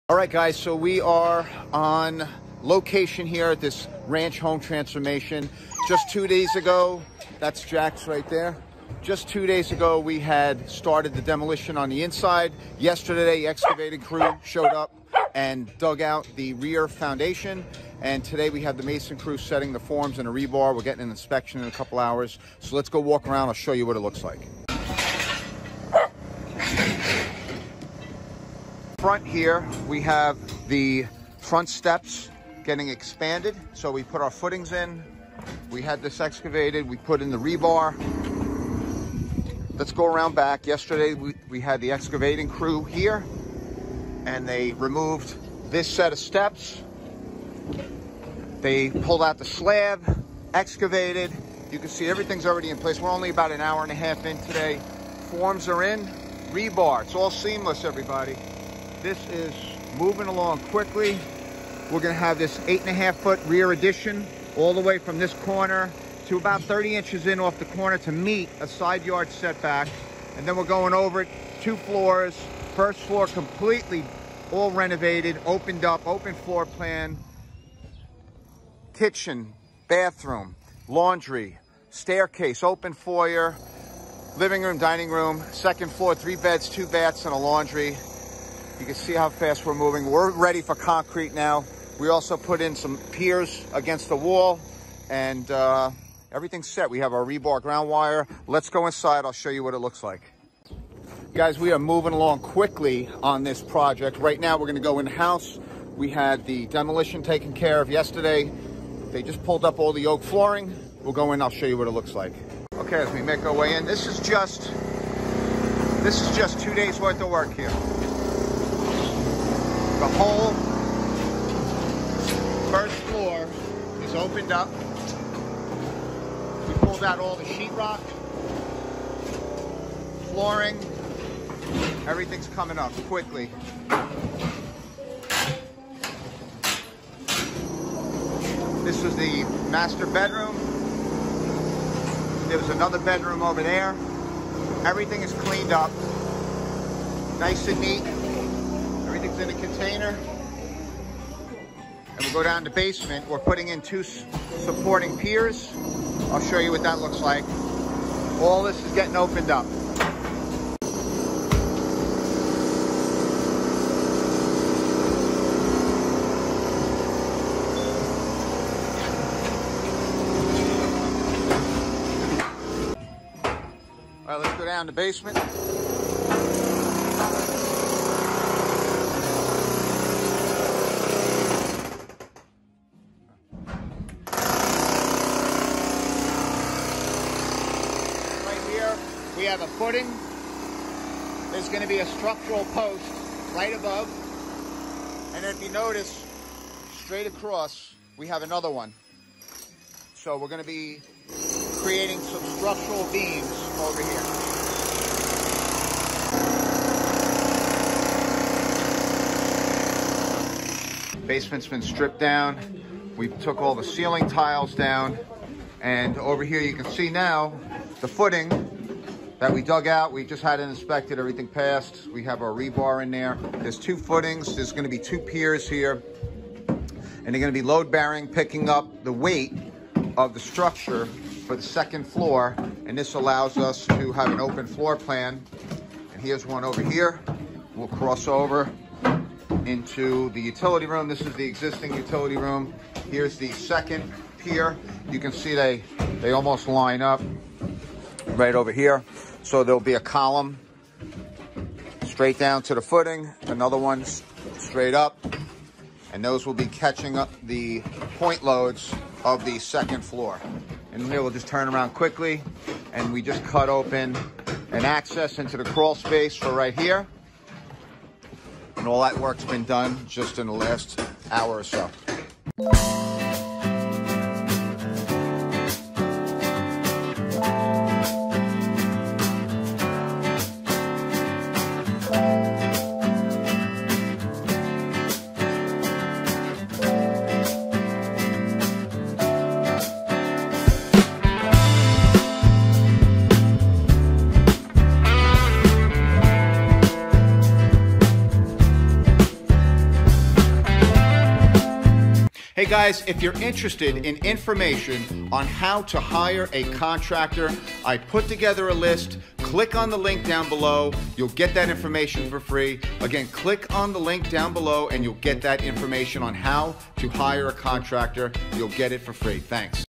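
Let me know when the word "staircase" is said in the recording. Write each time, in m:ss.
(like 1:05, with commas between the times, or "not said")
1:21.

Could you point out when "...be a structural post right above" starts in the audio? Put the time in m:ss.
3:11.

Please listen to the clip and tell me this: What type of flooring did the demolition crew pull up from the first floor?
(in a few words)
Oak flooring.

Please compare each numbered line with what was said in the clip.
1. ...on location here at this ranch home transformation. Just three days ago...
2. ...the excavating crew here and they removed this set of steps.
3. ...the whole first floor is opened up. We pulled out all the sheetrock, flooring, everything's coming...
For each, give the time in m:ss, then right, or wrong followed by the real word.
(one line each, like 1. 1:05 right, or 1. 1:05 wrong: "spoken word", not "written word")
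1. 0:01 wrong: "two", not "three"
2. 0:41 right
3. 2:00 right.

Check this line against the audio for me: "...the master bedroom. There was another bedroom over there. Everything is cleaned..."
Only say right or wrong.
right.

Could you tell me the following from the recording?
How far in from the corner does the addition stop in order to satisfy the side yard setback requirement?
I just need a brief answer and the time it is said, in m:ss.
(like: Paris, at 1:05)
30 inches, at 1:06.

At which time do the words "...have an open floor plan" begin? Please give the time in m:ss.
3:54.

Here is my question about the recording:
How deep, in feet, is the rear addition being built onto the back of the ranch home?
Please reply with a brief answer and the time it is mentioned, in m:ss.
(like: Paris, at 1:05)
8.5 feet, at 1:02.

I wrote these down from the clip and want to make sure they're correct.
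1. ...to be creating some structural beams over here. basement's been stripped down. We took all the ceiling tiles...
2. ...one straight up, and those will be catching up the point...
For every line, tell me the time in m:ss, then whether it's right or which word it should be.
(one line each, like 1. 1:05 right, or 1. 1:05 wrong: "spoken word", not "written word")
1. 3:20 right
2. 4:13 right.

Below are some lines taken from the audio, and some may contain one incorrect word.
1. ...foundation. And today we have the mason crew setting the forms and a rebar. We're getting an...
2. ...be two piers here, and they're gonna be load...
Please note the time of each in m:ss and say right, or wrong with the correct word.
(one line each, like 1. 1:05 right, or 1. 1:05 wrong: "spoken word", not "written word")
1. 0:16 right
2. 3:44 right.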